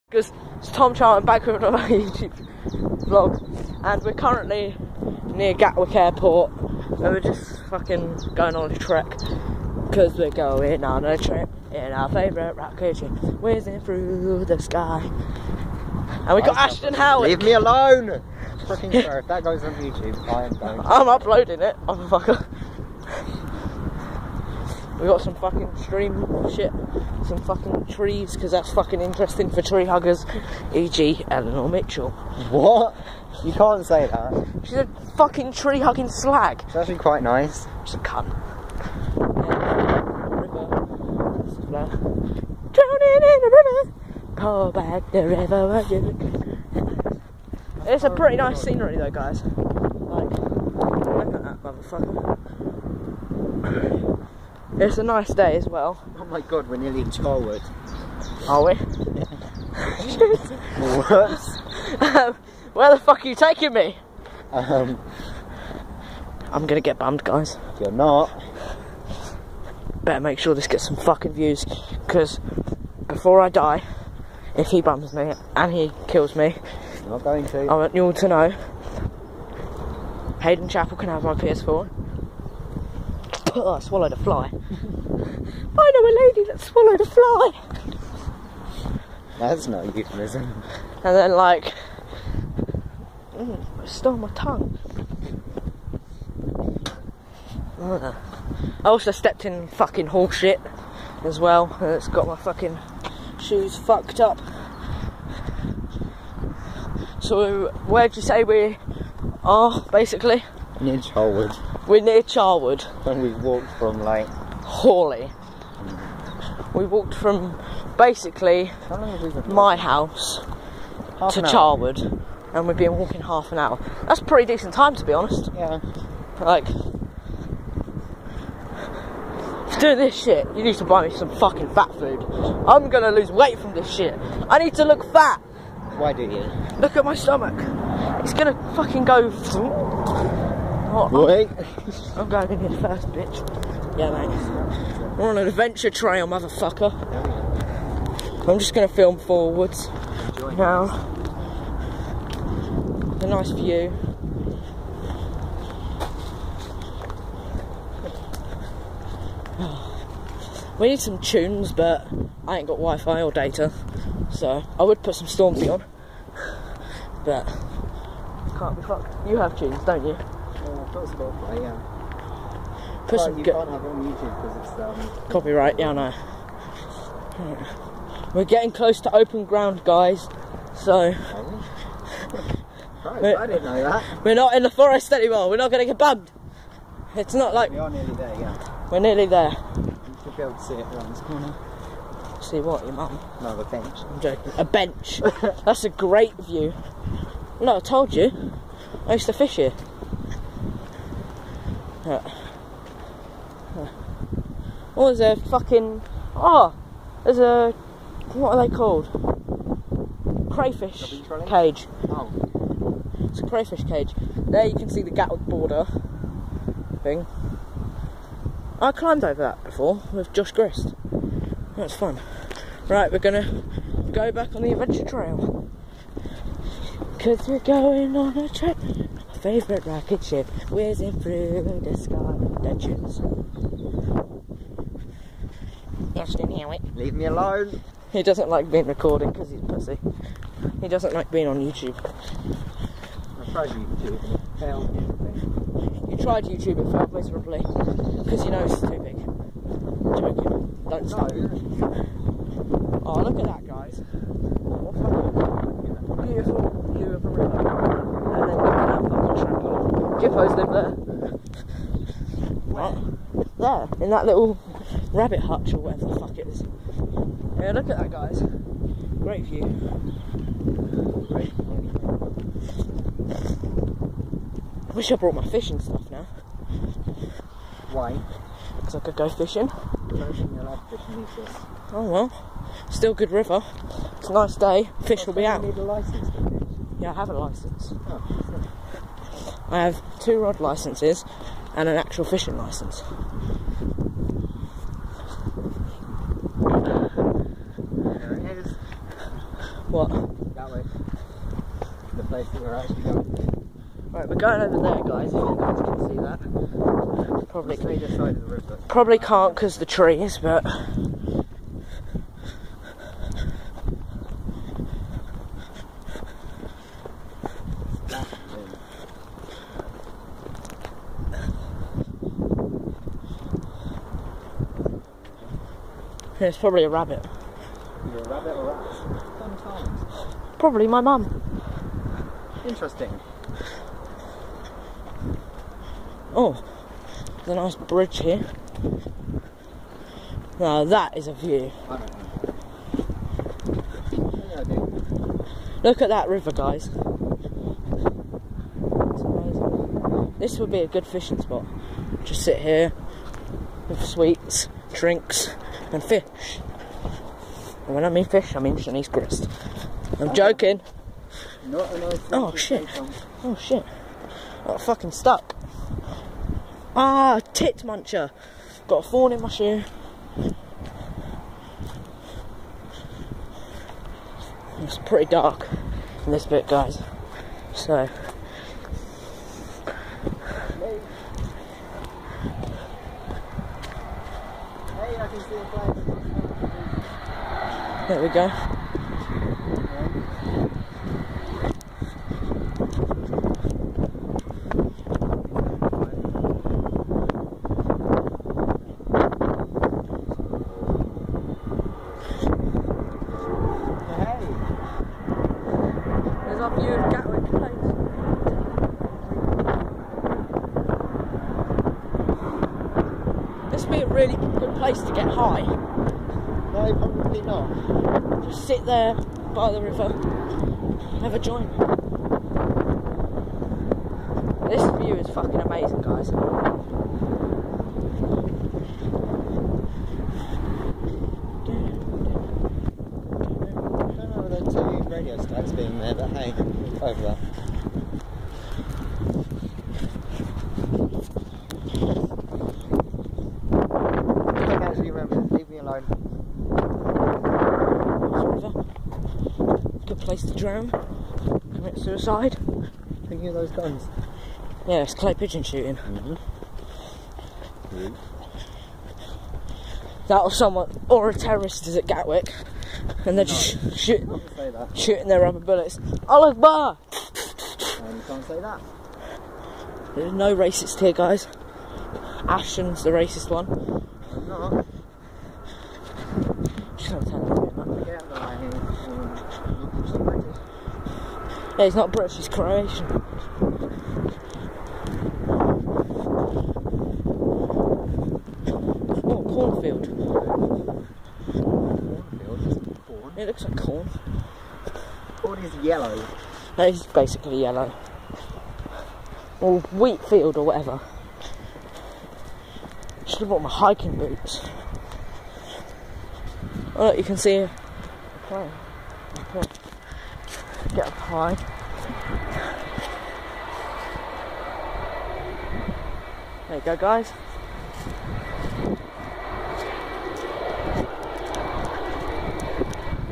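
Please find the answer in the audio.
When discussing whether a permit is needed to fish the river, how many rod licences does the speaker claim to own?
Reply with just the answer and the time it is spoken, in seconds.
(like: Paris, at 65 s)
2, at 290 s.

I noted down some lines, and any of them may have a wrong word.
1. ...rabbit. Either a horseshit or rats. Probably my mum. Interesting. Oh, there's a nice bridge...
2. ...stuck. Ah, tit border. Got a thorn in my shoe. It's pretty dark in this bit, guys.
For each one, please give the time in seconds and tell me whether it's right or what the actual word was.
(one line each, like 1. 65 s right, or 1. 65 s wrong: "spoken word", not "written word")
1. 326 s wrong: "rabbit", not "horseshit"
2. 365 s wrong: "muncher", not "border".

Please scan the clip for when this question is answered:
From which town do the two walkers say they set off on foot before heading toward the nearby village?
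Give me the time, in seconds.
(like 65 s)
114 s.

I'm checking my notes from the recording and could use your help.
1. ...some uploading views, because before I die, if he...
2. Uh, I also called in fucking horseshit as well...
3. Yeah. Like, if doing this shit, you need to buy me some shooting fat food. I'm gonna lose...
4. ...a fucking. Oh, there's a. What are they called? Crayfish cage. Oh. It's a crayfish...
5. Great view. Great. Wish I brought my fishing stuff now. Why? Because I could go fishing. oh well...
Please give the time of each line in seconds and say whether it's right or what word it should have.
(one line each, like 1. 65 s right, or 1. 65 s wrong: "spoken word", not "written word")
1. 70 s wrong: "fucking", not "uploading"
2. 97 s wrong: "stepped", not "called"
3. 125 s wrong: "fucking", not "shooting"
4. 205 s right
5. 269 s right.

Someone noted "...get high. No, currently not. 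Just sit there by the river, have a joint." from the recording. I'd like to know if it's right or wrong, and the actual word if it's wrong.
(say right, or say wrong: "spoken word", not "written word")
wrong: "probably", not "currently".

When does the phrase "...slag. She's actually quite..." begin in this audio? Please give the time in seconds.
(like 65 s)
36 s.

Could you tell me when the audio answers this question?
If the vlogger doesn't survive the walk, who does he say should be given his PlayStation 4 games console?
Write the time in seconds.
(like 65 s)
80 s.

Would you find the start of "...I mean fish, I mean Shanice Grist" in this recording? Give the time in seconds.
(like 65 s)
358 s.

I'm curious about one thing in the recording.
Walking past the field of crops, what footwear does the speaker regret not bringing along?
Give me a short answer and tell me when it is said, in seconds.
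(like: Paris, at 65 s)
Hiking boots, at 503 s.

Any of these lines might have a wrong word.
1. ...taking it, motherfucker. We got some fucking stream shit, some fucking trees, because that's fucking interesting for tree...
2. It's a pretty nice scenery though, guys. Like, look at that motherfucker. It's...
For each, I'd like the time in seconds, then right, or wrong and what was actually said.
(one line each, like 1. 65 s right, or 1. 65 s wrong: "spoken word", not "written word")
1. 21 s wrong: "uploading", not "taking"
2. 47 s right.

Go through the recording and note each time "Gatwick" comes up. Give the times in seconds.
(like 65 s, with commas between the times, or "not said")
5 s, 215 s, 462 s.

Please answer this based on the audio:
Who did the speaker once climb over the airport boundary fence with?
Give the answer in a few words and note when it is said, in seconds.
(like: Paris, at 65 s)
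Josh Grist, at 220 s.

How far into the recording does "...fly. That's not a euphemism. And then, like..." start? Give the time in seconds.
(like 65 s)
87 s.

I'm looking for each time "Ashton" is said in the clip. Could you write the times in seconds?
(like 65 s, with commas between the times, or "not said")
16 s, 472 s.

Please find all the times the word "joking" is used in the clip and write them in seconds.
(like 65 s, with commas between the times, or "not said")
194 s, 250 s, 360 s.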